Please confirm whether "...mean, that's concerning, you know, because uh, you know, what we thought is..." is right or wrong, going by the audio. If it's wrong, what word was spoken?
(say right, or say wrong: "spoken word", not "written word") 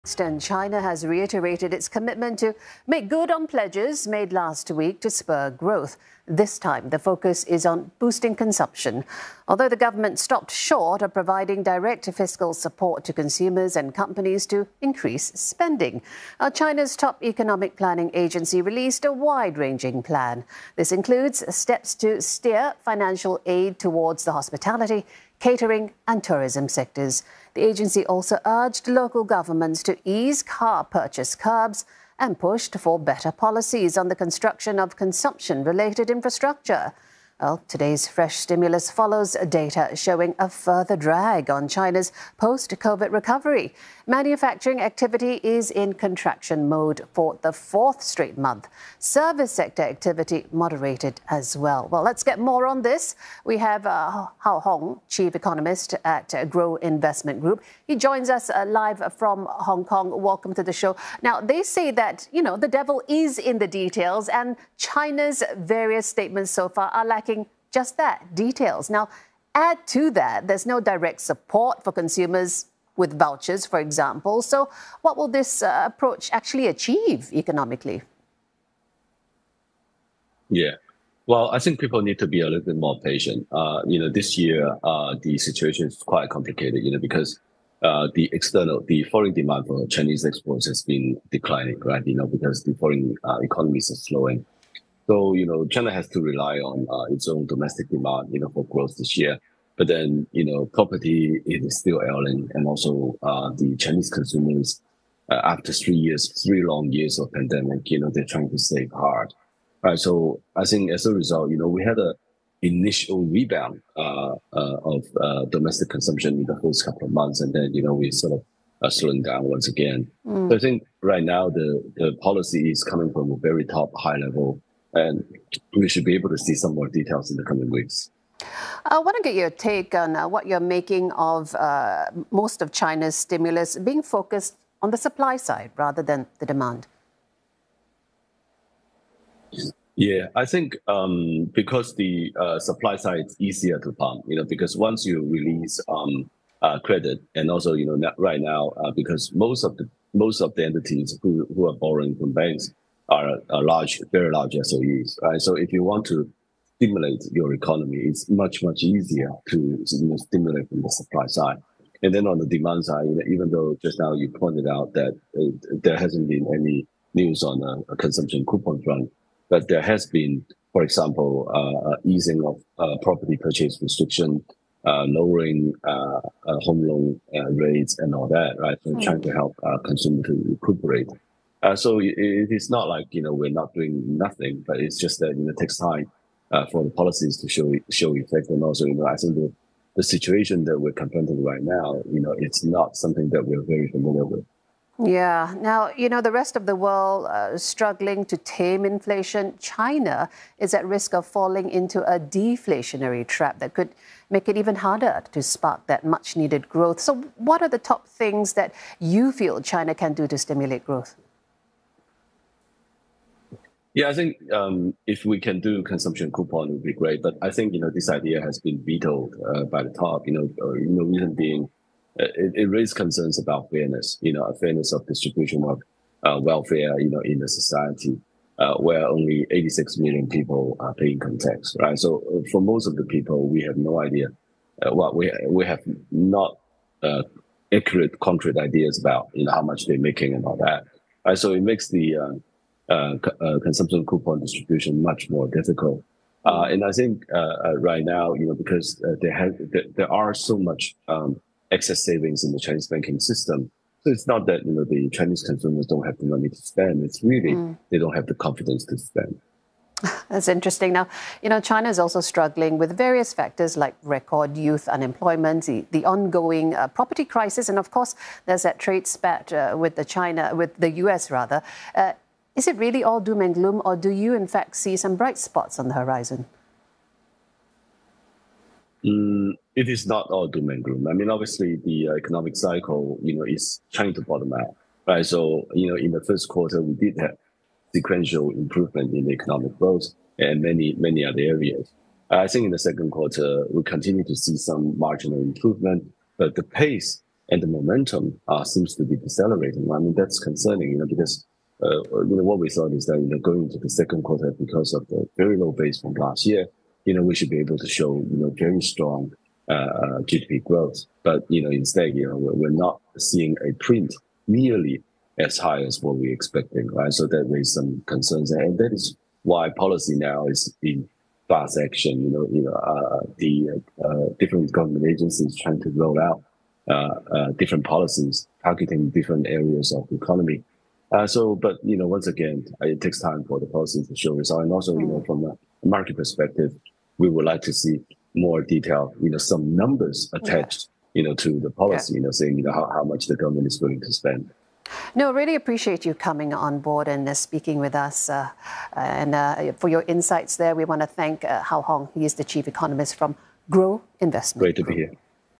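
right.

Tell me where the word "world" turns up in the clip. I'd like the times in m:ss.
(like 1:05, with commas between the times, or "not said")
3:16.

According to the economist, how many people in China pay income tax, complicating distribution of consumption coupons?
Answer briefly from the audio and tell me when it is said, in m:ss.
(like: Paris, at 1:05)
86 million, at 3:49.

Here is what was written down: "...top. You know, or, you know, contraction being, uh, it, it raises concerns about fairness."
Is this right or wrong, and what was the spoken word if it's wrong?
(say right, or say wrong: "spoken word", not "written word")
wrong: "reason", not "contraction".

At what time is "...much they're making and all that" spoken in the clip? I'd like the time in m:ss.
3:59.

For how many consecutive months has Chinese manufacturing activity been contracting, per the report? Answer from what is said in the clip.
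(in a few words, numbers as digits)
4.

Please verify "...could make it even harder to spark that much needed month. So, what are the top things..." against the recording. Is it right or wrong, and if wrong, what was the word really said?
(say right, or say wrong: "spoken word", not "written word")
wrong: "growth", not "month".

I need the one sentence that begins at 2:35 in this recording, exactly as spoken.
So if you want to stimulate your economy, it's much, much easier to you know, stimulate from the supply side.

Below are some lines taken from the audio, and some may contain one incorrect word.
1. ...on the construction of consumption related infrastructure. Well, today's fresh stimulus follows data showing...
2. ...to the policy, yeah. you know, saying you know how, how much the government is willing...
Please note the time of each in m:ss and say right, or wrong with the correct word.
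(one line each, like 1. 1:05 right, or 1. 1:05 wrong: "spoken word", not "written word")
1. 0:33 right
2. 5:41 right.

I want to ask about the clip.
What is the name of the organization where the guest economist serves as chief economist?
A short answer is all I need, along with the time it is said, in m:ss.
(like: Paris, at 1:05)
Grow Investment Group, at 0:56.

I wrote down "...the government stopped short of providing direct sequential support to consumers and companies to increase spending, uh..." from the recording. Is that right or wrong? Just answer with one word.
wrong.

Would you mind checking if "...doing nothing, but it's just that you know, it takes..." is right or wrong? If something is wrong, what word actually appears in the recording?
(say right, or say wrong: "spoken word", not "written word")
right.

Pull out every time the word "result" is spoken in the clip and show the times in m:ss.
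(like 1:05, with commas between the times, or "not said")
1:51, 5:34.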